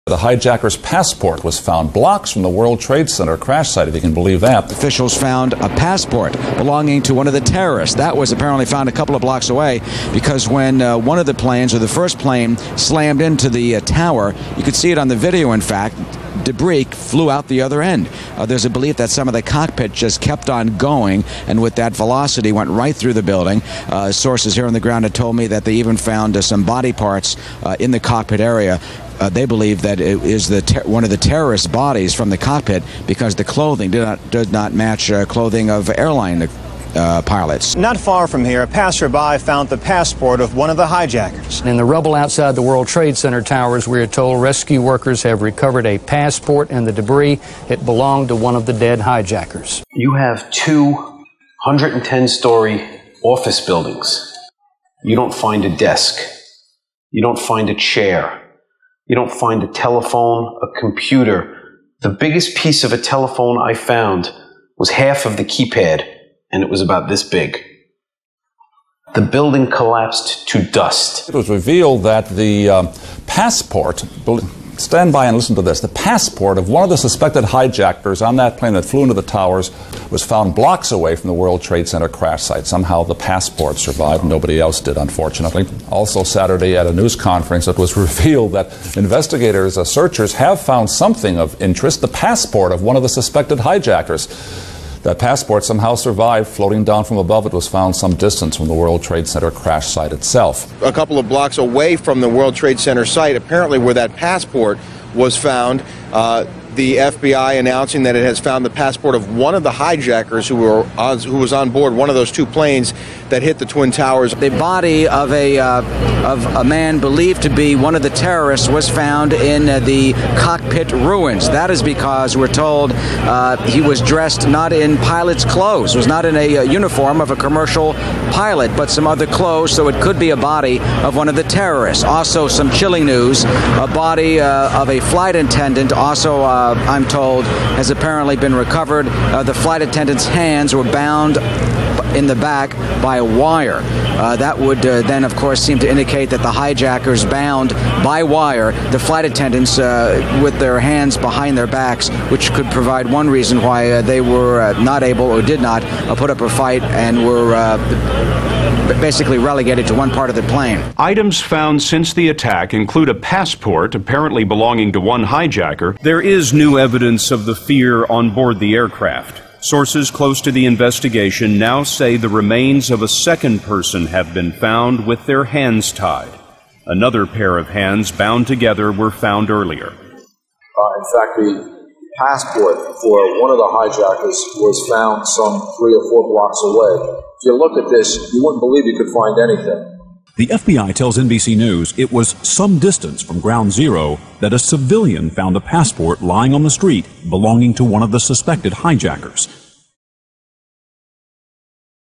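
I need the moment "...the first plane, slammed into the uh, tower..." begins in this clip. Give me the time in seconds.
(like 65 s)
11 s.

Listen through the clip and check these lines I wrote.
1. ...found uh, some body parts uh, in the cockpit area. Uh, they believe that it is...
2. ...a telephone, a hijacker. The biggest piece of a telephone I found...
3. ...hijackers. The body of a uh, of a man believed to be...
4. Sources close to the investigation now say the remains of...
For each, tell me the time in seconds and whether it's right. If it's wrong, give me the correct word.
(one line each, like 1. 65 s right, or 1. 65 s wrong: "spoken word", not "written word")
1. 25 s right
2. 59 s wrong: "computer", not "hijacker"
3. 113 s wrong: "towers", not "hijackers"
4. 169 s right.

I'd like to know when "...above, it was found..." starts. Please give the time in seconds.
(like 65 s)
97 s.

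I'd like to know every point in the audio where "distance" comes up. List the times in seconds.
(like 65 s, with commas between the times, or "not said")
98 s, 192 s.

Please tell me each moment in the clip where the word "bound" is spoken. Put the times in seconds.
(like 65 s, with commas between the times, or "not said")
140 s, 147 s, 178 s.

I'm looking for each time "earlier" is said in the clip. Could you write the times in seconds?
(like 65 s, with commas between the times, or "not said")
179 s.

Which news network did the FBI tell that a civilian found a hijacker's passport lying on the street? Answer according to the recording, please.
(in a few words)
NBC News.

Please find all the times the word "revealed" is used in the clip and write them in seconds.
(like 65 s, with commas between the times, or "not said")
71 s, 87 s.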